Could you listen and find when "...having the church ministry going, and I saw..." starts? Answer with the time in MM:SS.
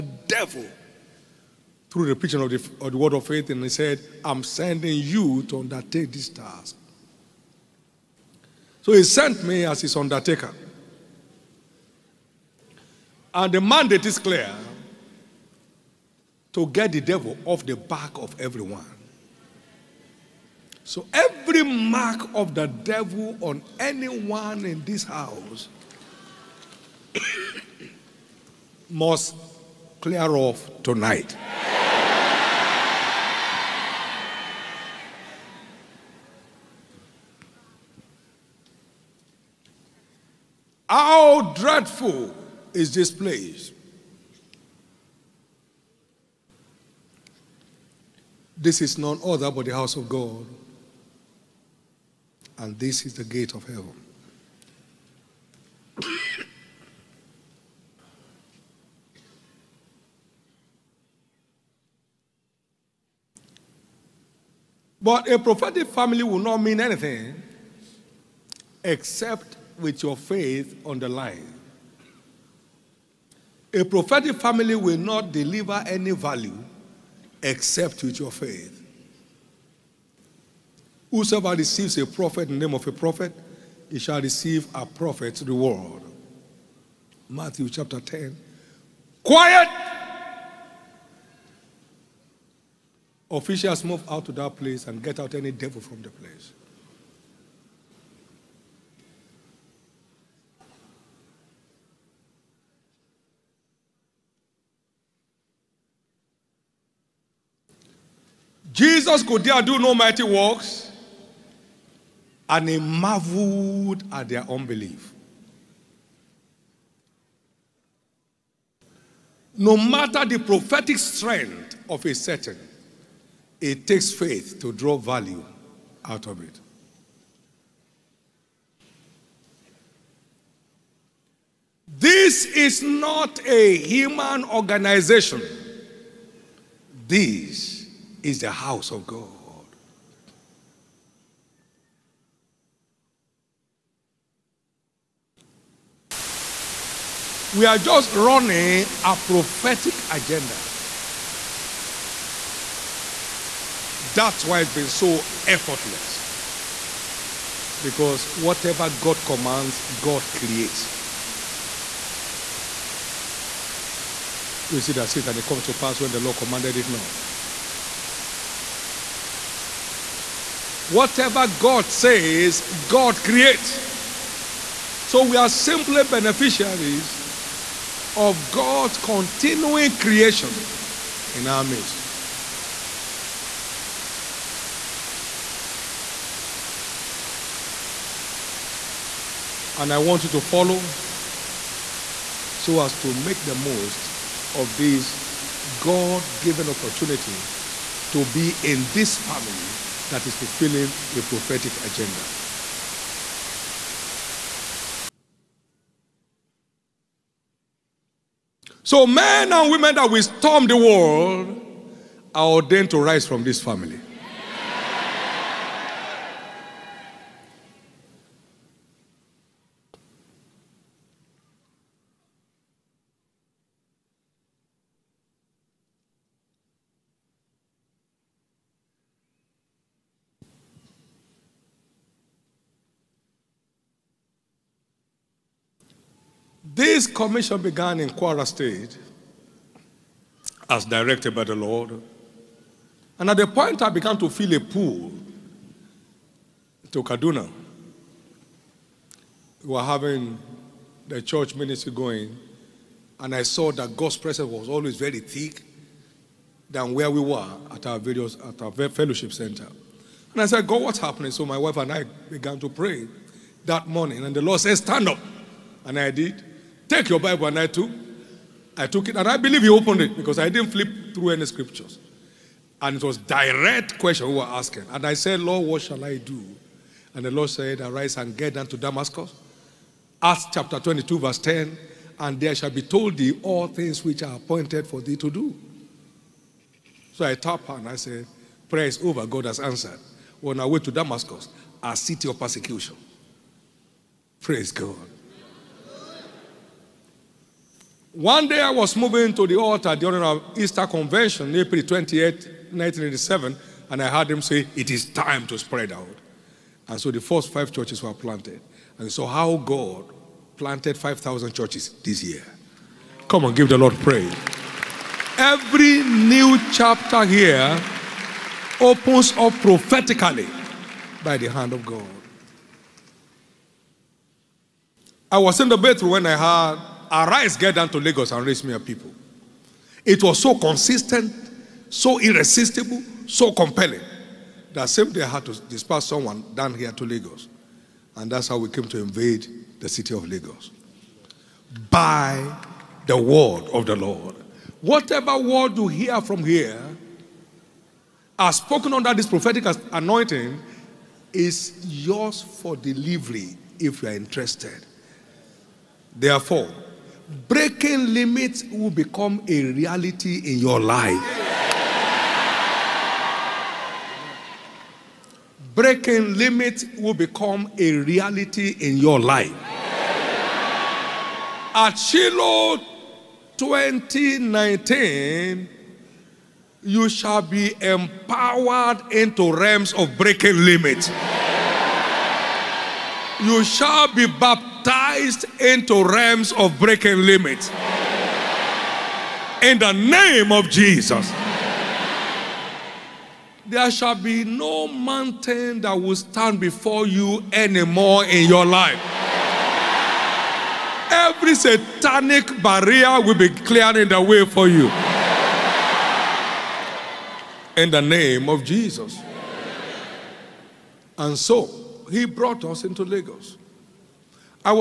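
04:09.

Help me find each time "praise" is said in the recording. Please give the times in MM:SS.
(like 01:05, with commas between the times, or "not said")
04:54, 05:13.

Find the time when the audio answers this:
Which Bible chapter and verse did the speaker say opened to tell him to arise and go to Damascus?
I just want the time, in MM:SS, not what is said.
04:40.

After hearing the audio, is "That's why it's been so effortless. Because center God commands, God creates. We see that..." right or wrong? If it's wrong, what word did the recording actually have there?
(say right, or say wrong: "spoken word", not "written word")
wrong: "whatever", not "center".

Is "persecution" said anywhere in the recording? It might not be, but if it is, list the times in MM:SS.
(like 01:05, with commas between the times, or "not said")
04:52.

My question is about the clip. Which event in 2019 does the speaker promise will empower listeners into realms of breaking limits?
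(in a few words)
Shiloh 2019.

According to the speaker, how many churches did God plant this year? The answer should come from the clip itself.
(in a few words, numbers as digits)
5,000.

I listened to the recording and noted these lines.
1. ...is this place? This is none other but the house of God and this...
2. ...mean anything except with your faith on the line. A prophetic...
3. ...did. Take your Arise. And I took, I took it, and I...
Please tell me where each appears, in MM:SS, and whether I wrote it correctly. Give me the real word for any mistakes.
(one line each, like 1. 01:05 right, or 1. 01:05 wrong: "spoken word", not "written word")
1. 00:42 right
2. 01:06 right
3. 04:26 wrong: "Bible", not "Arise".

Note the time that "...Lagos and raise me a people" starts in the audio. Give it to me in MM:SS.
05:27.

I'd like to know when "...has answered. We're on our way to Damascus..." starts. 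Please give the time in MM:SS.
04:49.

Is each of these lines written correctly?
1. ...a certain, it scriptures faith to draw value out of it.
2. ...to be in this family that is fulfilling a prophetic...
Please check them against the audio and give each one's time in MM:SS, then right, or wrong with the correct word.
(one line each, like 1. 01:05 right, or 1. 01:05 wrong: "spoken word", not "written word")
1. 02:02 wrong: "takes", not "scriptures"
2. 03:18 right.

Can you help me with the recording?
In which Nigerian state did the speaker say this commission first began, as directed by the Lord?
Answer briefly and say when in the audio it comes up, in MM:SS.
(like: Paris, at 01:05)
Kwara State, at 03:58.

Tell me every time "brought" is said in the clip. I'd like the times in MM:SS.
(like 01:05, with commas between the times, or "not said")
06:52.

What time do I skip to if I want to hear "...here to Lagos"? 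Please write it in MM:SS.
05:36.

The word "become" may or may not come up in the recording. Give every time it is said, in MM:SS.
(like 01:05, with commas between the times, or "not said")
05:58, 06:07.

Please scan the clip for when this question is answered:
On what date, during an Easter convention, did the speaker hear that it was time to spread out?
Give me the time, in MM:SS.
05:01.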